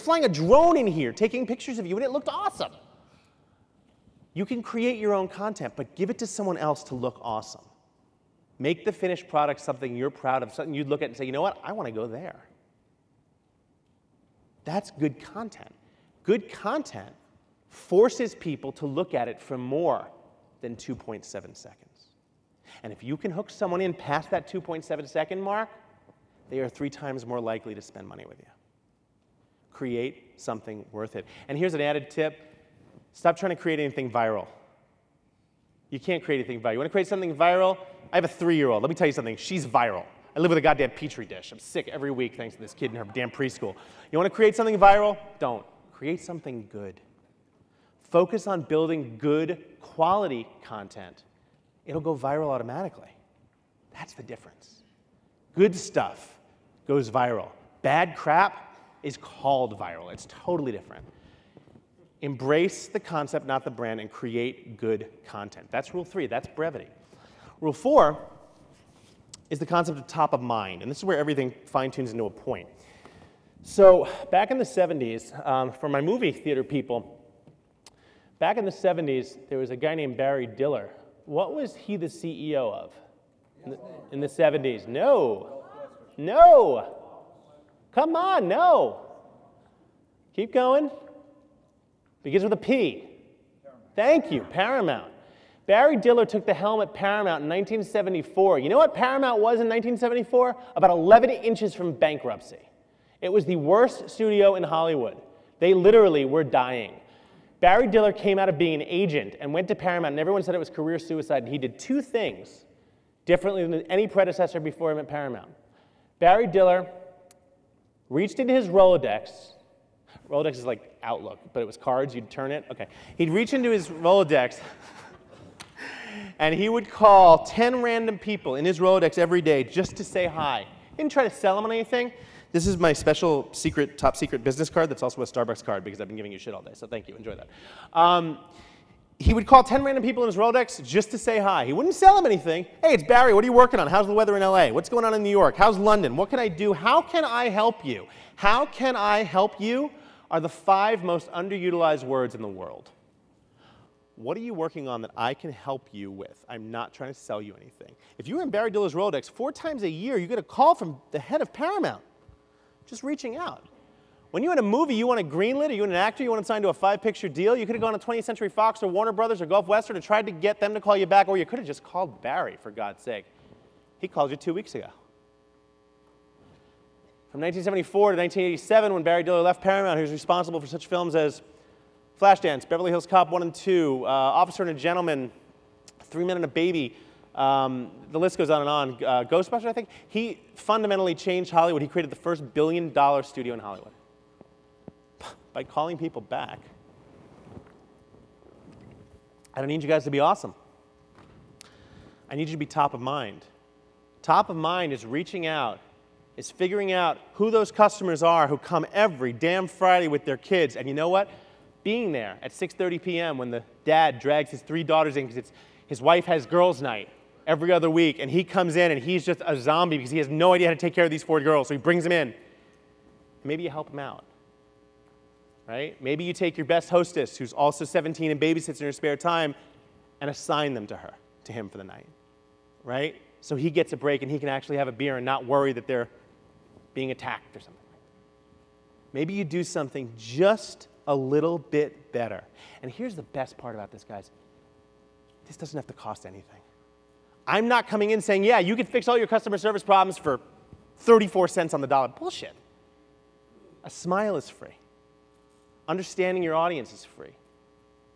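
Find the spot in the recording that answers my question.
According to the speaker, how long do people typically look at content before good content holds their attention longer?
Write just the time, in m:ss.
0:20.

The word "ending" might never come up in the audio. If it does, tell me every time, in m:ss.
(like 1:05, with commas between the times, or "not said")
not said.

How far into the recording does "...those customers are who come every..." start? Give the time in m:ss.
3:27.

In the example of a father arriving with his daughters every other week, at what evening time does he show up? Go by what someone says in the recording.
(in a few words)
6:30 p.m.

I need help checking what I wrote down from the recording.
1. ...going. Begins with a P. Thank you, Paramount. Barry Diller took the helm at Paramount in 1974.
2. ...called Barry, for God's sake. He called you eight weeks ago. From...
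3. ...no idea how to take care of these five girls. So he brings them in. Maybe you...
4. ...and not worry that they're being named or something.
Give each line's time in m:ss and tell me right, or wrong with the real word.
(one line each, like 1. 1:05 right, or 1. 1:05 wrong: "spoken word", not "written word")
1. 1:30 right
2. 2:51 wrong: "two", not "eight"
3. 3:40 wrong: "four", not "five"
4. 3:55 wrong: "attacked", not "named".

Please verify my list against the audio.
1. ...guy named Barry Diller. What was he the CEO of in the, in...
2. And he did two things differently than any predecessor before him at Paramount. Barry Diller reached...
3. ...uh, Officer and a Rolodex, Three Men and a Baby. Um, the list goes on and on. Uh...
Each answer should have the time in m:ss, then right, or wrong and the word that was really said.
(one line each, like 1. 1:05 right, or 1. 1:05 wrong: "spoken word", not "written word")
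1. 1:19 right
2. 1:51 right
3. 3:04 wrong: "Gentleman", not "Rolodex".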